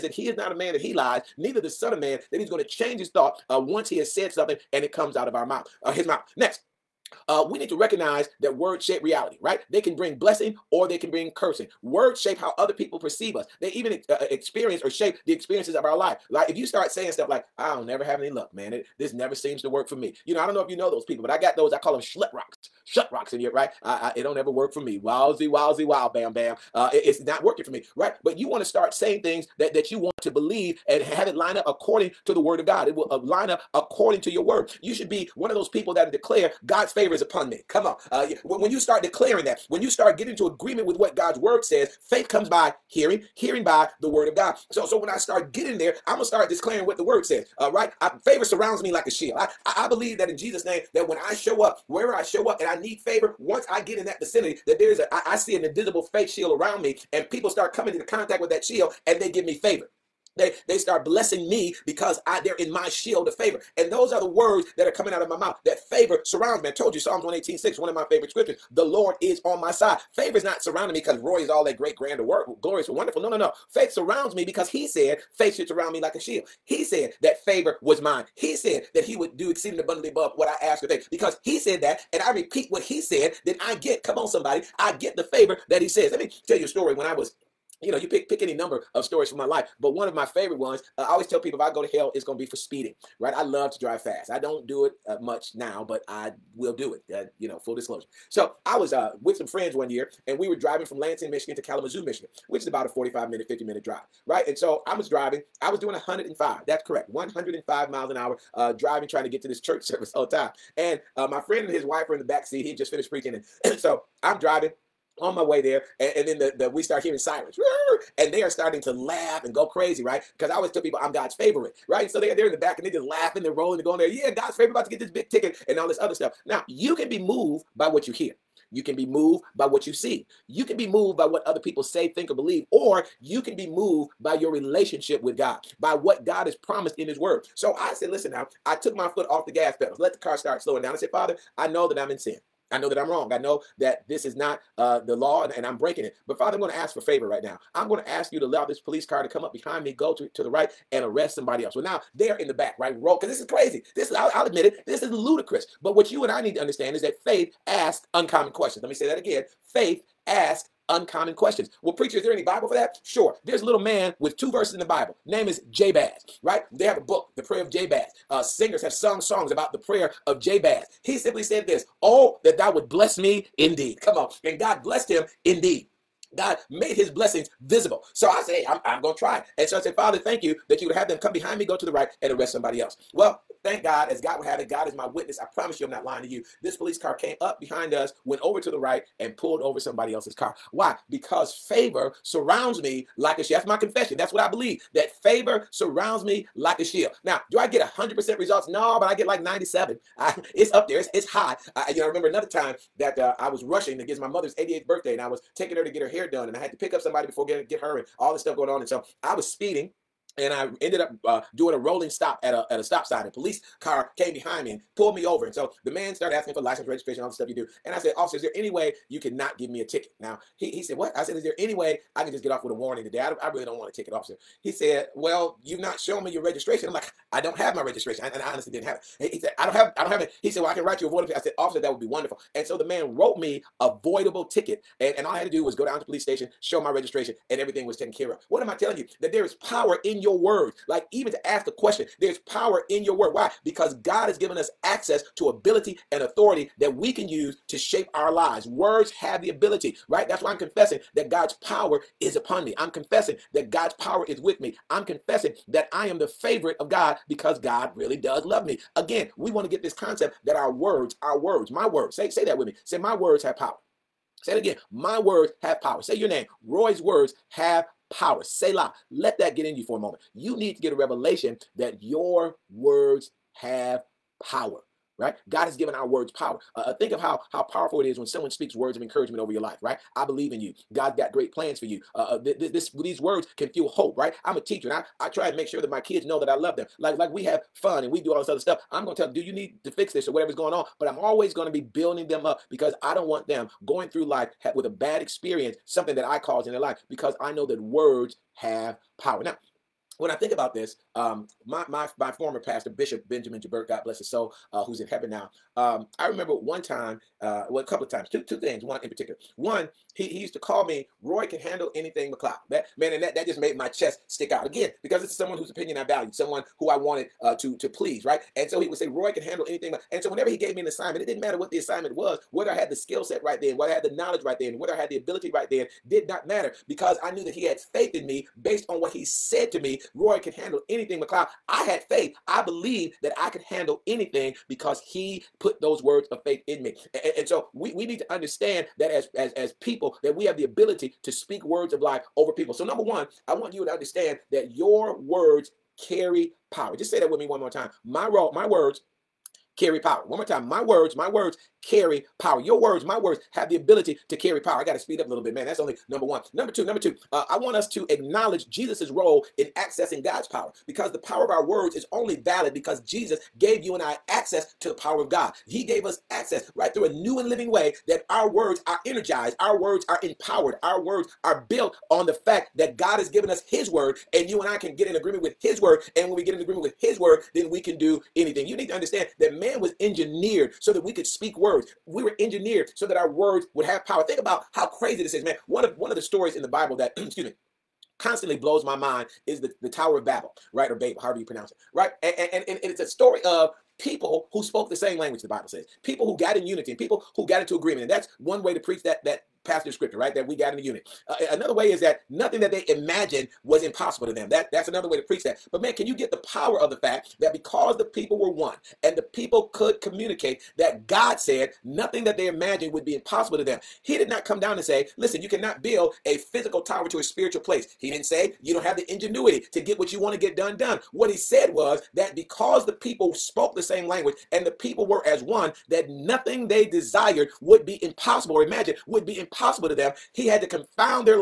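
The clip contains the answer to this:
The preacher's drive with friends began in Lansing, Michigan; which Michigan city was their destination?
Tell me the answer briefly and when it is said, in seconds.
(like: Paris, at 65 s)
Kalamazoo, at 101 s.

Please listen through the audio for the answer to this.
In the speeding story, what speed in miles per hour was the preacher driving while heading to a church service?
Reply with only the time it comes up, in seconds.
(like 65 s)
105 s.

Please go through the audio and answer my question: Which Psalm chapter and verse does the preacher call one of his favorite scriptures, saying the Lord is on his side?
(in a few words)
Psalms 118:6.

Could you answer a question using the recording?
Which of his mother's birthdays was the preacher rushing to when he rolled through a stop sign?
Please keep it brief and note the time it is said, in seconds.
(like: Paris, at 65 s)
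88th, at 204 s.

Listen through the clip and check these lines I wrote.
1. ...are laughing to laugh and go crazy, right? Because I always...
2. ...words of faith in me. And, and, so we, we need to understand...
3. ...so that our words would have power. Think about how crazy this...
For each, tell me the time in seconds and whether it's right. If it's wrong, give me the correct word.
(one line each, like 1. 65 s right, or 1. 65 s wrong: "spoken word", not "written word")
1. 118 s wrong: "starting", not "laughing"
2. 336 s right
3. 382 s right.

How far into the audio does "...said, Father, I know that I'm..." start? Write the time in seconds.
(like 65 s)
140 s.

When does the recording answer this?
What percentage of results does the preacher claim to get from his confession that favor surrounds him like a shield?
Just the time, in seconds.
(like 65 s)
199 s.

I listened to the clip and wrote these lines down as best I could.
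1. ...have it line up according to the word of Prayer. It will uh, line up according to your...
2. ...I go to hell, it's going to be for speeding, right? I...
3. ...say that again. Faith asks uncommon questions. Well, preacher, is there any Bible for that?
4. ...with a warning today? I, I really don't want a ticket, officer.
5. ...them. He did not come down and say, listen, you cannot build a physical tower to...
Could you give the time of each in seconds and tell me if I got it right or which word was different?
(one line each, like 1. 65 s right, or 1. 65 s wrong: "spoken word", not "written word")
1. 31 s wrong: "God", not "Prayer"
2. 91 s right
3. 158 s right
4. 222 s right
5. 413 s right.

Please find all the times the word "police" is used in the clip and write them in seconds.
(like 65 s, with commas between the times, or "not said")
148 s, 186 s, 213 s, 236 s.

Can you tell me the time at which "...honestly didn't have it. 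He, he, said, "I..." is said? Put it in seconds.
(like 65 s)
228 s.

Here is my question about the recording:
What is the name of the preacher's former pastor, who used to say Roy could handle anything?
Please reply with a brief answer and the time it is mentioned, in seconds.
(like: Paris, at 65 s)
Bishop Benjamin Jabert, at 302 s.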